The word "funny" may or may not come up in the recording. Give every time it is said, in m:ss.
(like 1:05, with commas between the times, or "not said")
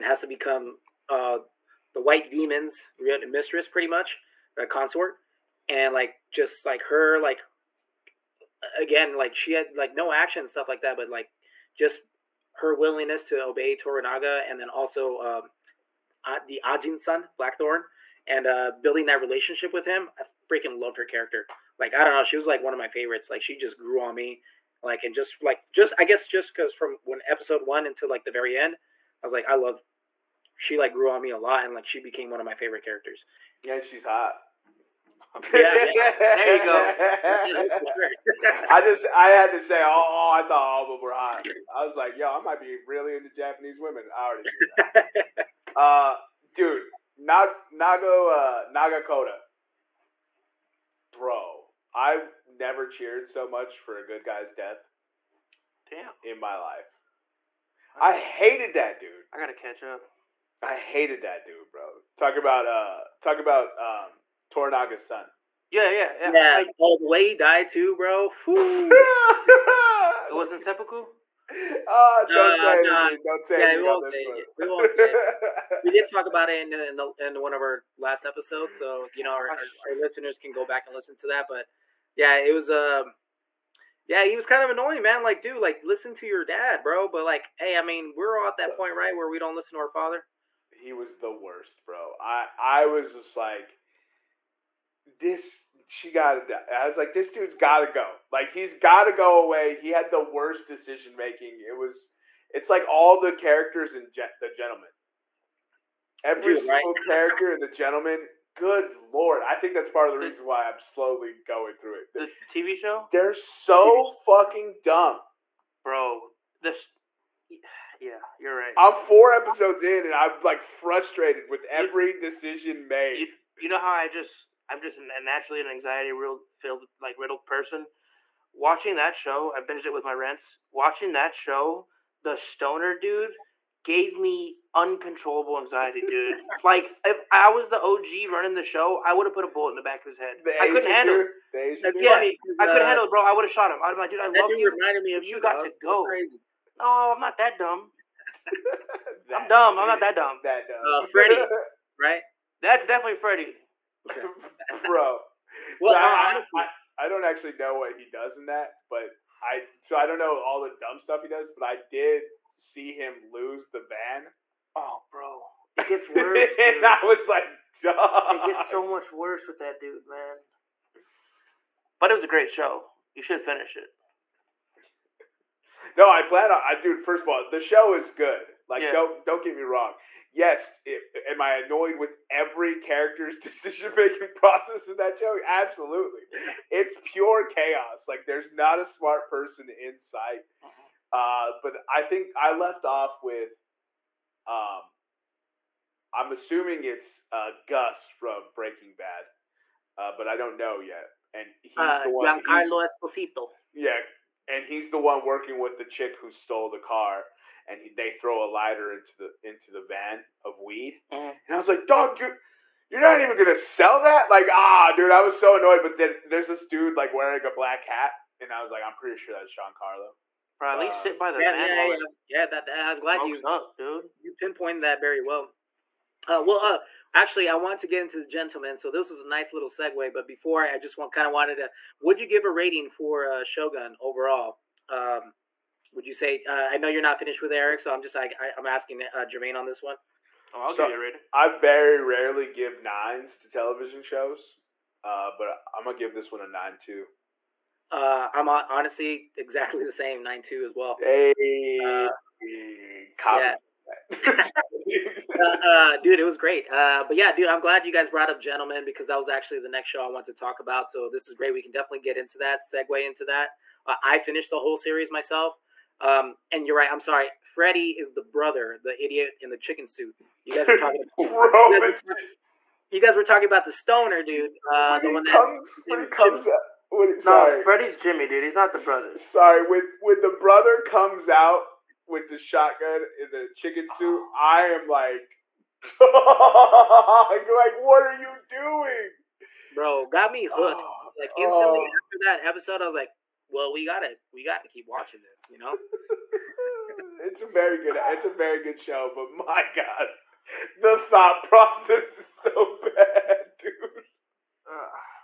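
2:22.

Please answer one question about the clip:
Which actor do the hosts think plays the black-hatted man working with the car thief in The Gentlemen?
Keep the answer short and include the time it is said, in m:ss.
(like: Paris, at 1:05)
Giancarlo Esposito, at 3:22.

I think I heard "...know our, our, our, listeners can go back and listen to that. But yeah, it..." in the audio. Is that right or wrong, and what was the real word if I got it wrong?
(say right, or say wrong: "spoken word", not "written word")
right.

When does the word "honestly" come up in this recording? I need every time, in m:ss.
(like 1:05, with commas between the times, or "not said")
2:36, 4:08.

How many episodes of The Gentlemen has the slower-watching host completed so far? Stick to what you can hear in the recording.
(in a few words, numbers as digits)
4.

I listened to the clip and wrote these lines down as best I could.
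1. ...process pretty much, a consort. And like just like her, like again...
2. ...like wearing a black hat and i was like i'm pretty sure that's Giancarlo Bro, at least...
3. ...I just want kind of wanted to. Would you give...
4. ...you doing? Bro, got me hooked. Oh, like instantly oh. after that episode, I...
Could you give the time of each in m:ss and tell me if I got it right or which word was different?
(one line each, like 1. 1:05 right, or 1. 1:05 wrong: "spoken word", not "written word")
1. 0:02 wrong: "mistress", not "process"
2. 3:36 right
3. 3:50 right
4. 4:48 right.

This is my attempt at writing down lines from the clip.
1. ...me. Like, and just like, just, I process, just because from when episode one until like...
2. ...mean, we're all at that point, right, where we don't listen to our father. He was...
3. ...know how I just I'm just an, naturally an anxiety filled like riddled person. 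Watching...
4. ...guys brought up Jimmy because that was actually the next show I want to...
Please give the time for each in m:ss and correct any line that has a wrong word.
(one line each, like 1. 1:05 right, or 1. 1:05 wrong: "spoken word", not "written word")
1. 0:24 wrong: "guess", not "process"
2. 1:27 right
3. 2:03 right
4. 4:17 wrong: "Gentlemen", not "Jimmy".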